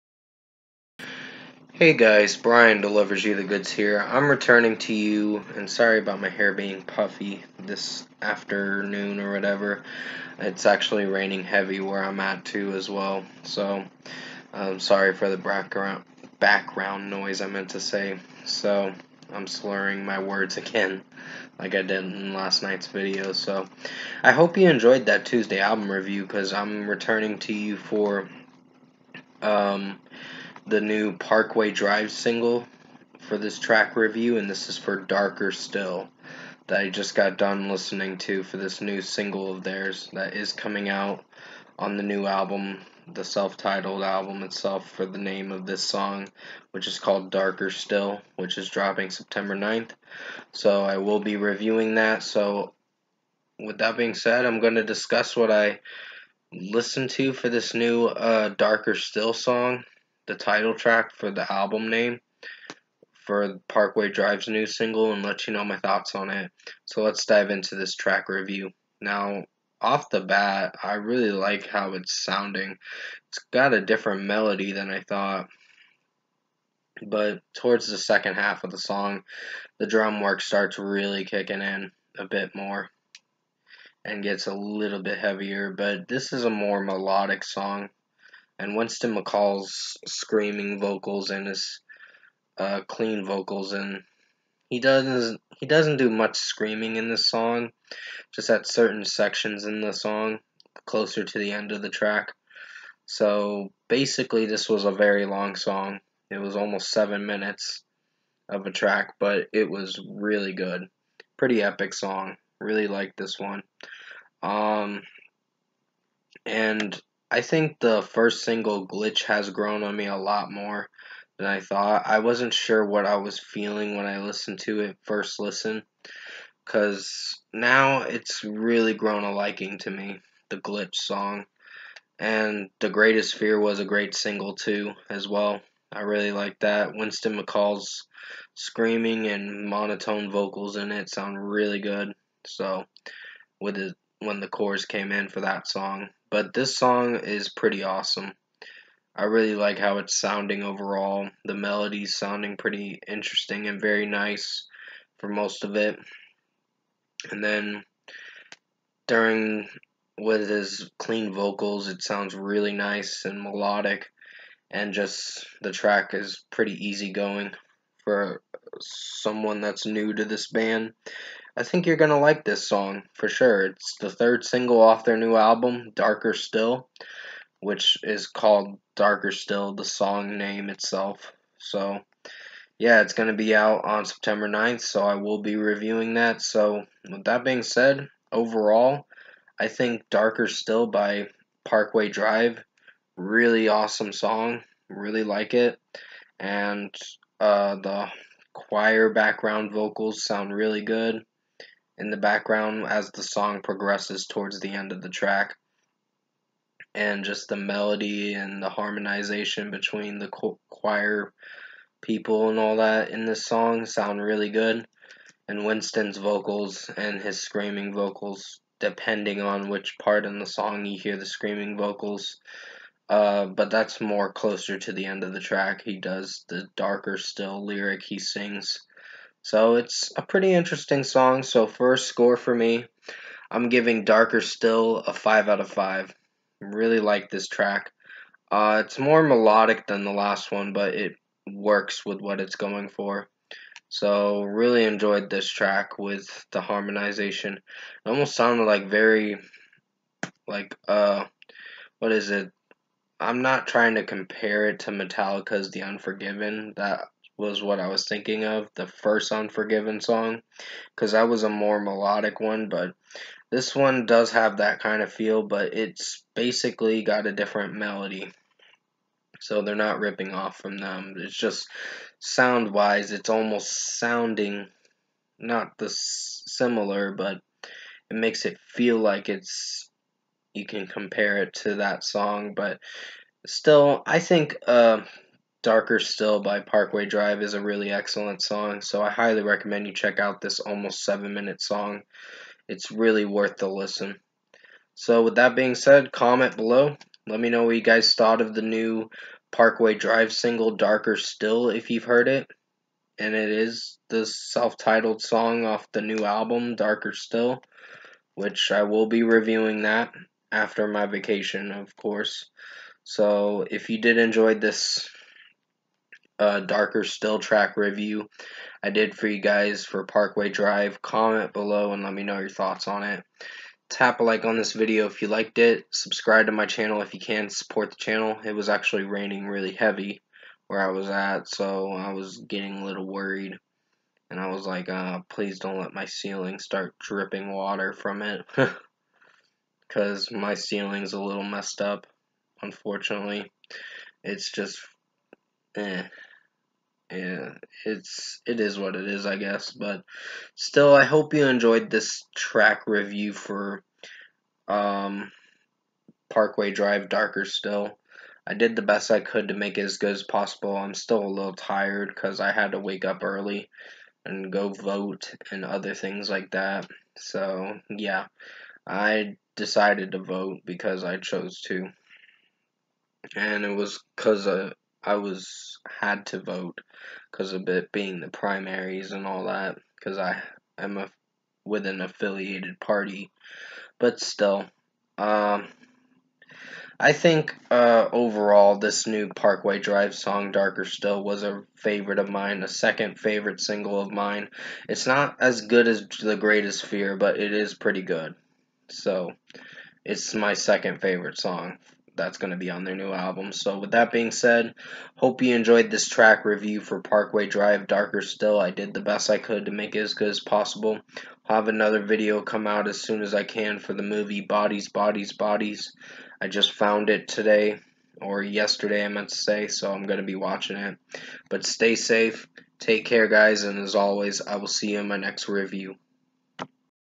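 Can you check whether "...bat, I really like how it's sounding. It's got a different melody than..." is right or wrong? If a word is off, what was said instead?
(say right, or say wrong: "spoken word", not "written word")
right.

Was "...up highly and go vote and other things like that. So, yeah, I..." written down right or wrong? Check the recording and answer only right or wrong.
wrong.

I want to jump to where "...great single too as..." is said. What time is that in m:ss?
2:13.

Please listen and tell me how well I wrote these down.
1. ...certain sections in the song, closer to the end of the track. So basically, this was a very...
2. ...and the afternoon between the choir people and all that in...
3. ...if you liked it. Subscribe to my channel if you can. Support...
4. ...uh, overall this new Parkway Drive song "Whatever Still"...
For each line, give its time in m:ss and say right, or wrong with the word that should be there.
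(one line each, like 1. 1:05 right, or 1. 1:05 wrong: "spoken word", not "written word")
1. 1:38 right
2. 3:28 wrong: "harmonization", not "afternoon"
3. 5:25 right
4. 6:27 wrong: "Darker", not "Whatever".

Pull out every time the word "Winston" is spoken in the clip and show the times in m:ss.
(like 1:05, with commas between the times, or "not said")
1:28, 2:16, 3:35.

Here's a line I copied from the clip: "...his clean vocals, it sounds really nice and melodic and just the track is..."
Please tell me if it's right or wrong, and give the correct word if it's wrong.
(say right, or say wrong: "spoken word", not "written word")
right.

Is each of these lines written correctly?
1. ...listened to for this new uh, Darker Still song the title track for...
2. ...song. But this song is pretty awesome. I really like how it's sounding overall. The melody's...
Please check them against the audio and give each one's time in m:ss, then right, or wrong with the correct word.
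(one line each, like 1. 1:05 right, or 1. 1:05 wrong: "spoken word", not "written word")
1. 0:56 right
2. 2:25 right.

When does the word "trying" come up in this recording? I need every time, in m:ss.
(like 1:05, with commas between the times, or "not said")
4:13.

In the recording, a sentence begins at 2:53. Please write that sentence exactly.
It's the third single off their new album, Darker Still, which is called Darker Still, the song name itself.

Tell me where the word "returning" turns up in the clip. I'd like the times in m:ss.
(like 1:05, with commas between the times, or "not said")
0:04, 0:26.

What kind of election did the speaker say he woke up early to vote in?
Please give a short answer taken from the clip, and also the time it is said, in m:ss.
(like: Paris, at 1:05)
the primaries, at 6:18.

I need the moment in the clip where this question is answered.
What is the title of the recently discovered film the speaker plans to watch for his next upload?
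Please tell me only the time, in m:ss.
6:54.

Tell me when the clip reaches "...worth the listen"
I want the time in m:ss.
4:53.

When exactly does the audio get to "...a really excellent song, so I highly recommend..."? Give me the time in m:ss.
4:47.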